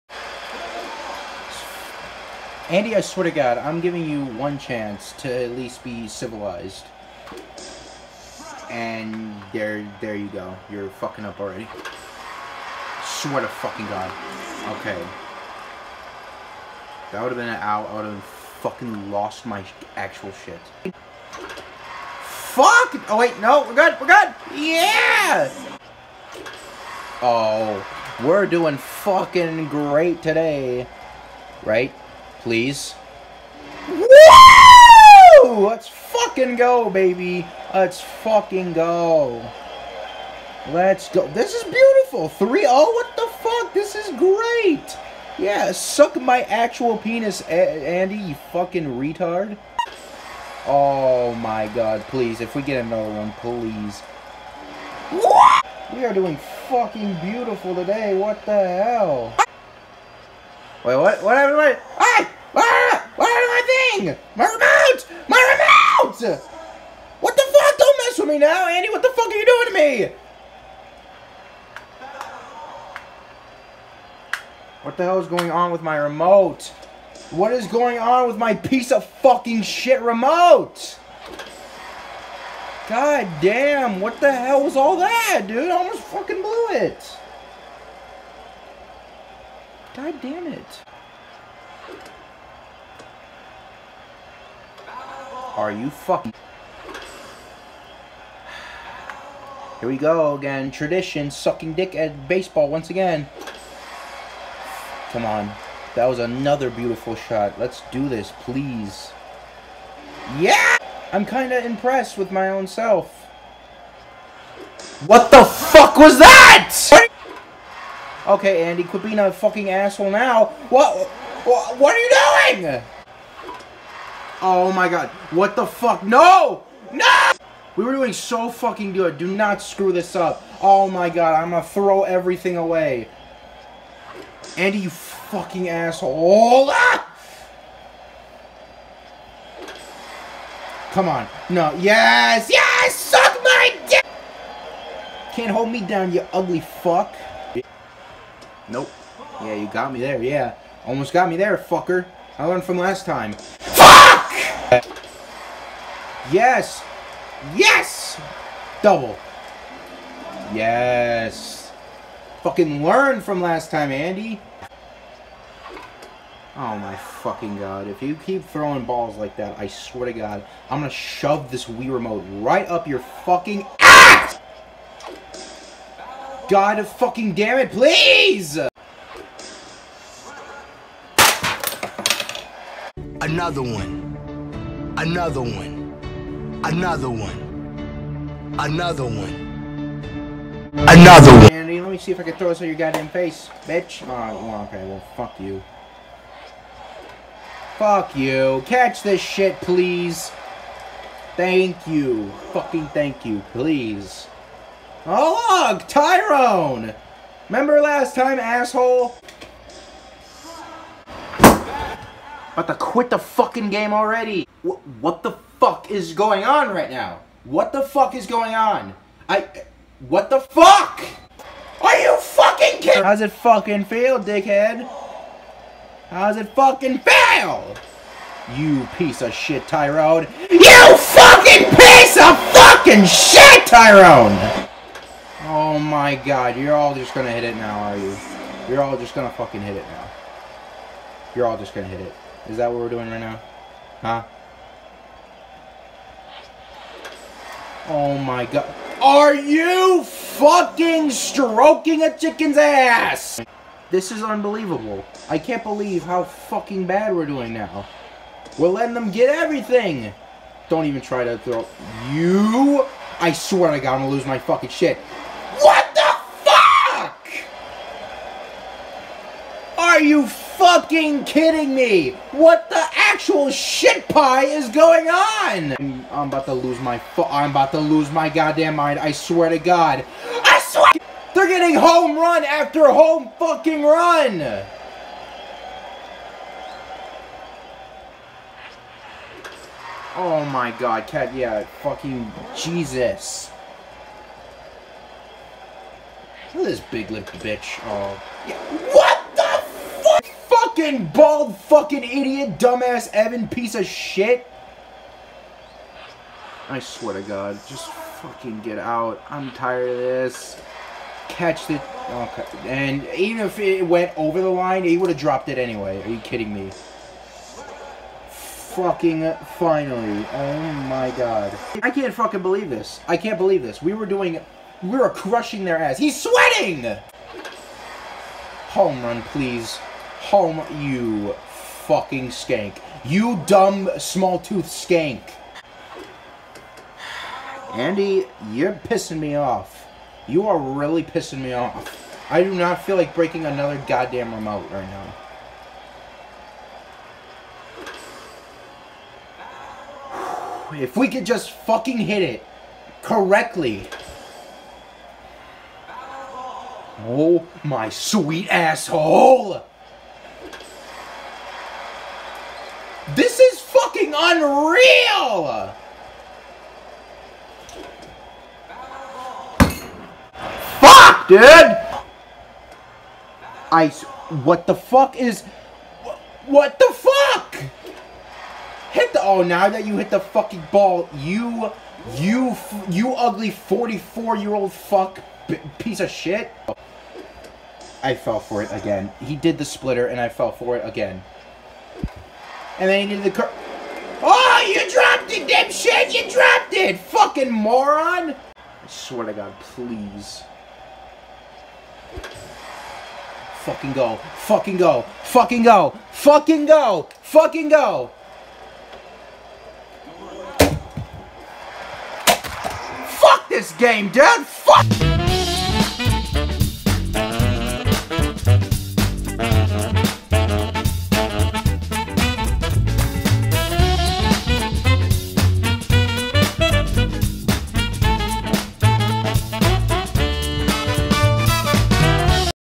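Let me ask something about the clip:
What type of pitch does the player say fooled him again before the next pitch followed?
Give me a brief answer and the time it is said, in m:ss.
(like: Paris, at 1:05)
Splitter, at 6:29.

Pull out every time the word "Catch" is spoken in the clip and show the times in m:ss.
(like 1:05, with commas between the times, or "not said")
3:18, 5:11.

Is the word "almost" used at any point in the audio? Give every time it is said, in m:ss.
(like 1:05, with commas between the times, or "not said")
1:25, 2:30.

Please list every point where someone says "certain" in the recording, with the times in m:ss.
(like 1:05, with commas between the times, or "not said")
not said.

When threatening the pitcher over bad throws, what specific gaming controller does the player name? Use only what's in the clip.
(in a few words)
Wii remote.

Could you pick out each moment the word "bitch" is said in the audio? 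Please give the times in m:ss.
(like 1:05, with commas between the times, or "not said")
3:13, 4:57.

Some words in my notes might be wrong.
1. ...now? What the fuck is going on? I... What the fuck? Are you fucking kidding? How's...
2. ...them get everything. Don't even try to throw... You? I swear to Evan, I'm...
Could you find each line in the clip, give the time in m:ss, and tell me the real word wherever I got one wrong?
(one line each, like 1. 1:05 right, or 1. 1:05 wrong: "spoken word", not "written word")
1. 3:36 right
2. 4:18 wrong: "God", not "Evan".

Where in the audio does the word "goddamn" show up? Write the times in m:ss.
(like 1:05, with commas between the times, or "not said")
3:12, 4:38, 5:43.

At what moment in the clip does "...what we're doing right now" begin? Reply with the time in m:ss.
4:02.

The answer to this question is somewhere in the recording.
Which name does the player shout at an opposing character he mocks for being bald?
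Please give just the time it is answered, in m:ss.
5:03.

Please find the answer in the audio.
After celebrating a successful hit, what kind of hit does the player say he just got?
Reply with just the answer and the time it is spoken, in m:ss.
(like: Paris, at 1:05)
Double, at 2:38.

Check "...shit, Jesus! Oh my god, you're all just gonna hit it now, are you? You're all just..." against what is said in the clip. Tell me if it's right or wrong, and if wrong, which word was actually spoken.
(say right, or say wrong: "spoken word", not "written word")
wrong: "Tyrone", not "Jesus".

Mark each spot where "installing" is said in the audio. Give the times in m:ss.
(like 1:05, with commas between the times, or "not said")
not said.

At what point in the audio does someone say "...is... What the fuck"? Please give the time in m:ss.
6:15.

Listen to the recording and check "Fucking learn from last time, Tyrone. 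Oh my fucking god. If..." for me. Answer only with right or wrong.
wrong.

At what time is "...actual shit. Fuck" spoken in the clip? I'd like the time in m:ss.
0:19.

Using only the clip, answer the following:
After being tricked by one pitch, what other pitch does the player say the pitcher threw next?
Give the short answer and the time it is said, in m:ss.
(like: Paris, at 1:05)
Curl, at 6:33.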